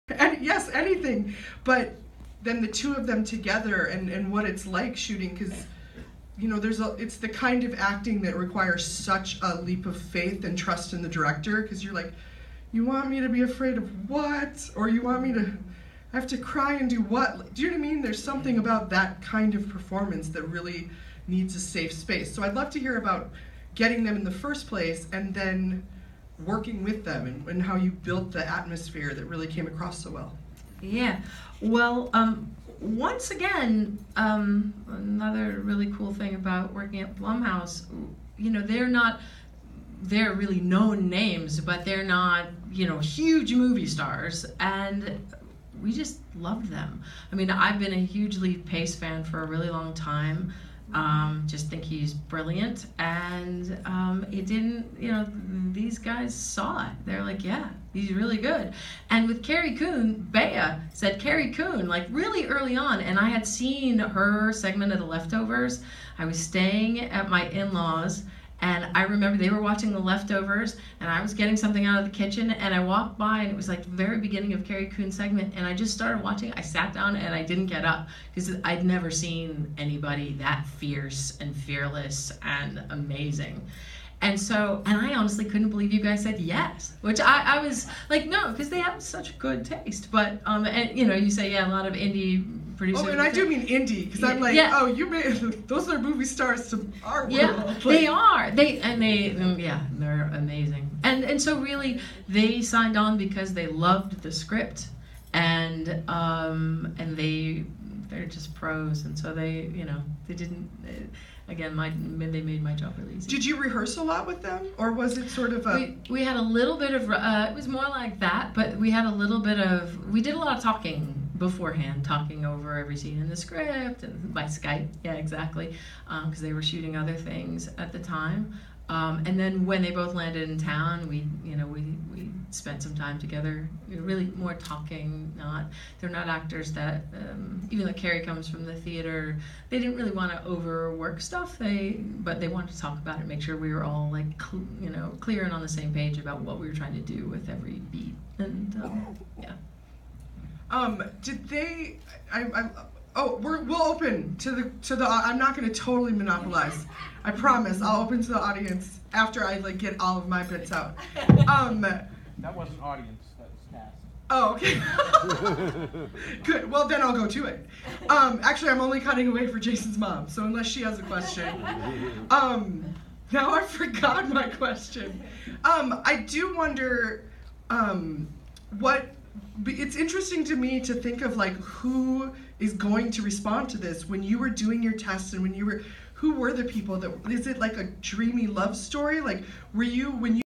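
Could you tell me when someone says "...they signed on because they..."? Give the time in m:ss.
1:42.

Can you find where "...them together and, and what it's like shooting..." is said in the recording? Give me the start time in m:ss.
0:03.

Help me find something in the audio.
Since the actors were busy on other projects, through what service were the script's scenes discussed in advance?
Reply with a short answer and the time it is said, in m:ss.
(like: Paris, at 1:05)
Skype, at 2:04.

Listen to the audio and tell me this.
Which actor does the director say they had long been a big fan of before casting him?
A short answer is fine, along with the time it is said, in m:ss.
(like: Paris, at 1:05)
Lee Pace, at 0:48.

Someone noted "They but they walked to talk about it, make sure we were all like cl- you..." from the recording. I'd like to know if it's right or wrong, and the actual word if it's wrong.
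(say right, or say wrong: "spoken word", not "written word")
wrong: "wanted", not "walked".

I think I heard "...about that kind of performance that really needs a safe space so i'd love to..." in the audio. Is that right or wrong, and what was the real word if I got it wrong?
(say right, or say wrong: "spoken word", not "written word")
right.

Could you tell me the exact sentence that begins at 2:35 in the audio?
I'm not going to totally monopolize.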